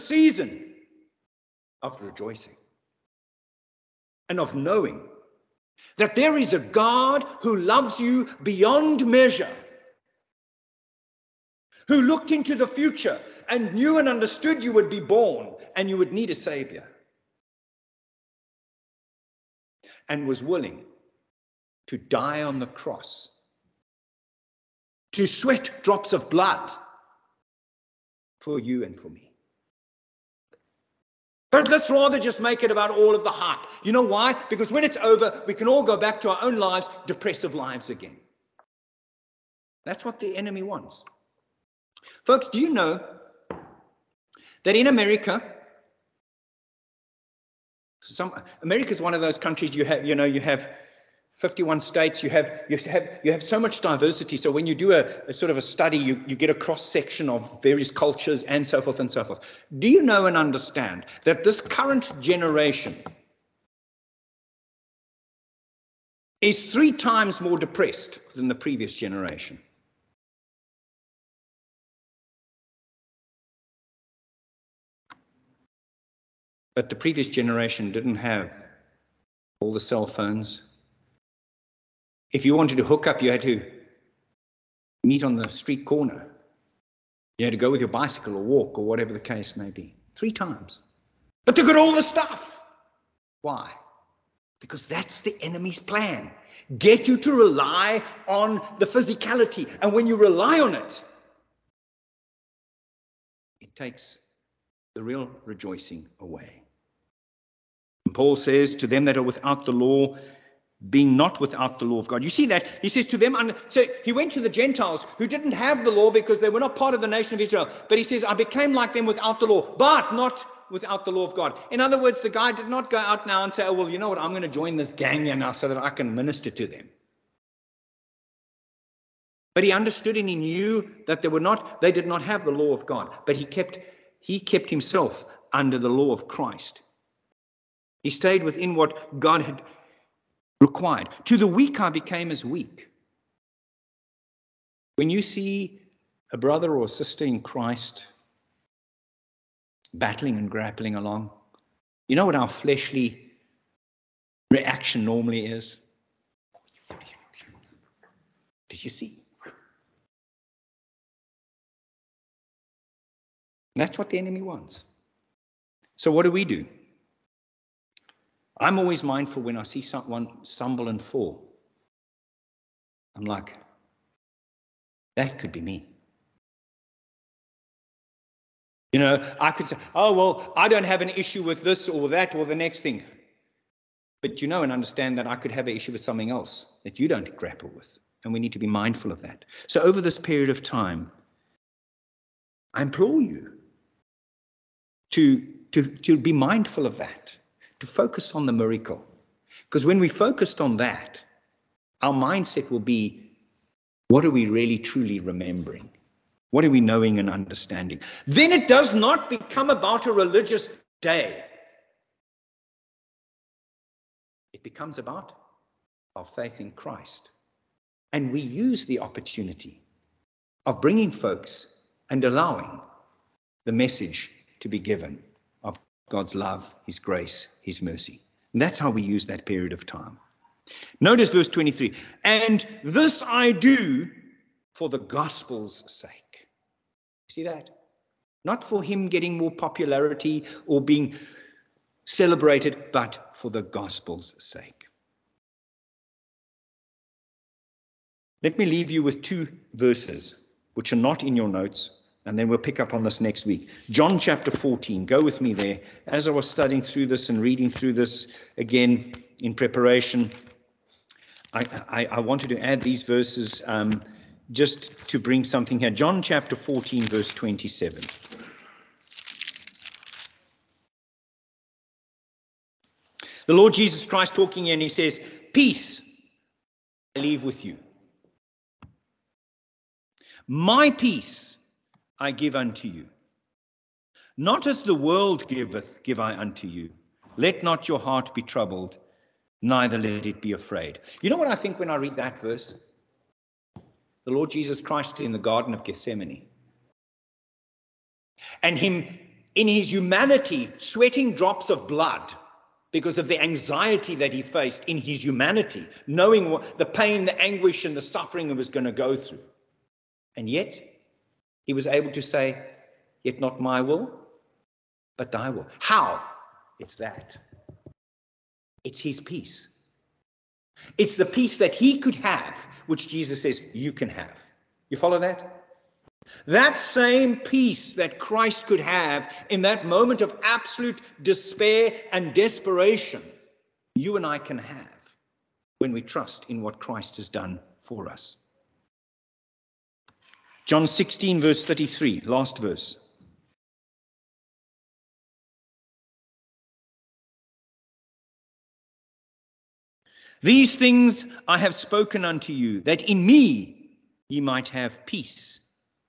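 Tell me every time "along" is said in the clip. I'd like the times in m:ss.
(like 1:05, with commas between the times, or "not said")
2:30.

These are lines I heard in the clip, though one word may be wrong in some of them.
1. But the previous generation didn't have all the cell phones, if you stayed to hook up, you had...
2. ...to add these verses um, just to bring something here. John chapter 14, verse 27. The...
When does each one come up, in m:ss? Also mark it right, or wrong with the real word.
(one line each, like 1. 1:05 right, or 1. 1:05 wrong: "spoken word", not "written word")
1. 1:16 wrong: "wanted", not "stayed"
2. 4:22 right.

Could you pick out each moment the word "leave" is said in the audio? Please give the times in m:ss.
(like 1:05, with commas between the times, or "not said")
4:08, 4:37.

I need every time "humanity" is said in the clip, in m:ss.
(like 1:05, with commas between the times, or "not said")
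4:59, 5:05.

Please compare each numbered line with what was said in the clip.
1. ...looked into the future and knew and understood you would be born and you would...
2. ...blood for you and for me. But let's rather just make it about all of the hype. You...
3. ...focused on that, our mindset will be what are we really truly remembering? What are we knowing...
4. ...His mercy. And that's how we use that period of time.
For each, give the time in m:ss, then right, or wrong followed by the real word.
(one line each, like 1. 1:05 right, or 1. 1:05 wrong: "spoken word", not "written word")
1. 0:12 right
2. 0:26 right
3. 3:20 right
4. 3:47 right.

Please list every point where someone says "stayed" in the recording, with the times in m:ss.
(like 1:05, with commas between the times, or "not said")
2:18.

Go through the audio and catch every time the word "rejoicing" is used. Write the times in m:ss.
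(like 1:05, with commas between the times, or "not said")
0:02, 1:45.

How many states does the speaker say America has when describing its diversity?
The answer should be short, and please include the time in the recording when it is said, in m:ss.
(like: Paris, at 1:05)
51, at 0:51.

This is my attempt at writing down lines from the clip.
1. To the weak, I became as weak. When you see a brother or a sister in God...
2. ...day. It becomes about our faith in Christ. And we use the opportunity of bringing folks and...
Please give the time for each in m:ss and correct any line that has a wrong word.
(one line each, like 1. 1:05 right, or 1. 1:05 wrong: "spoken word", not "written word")
1. 2:21 wrong: "Christ", not "God"
2. 3:31 right.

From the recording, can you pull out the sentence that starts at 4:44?
Not as the world giveth, give I unto you.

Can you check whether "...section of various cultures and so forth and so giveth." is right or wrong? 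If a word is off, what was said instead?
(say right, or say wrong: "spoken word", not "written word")
wrong: "forth", not "giveth".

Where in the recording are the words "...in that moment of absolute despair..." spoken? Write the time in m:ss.
5:29.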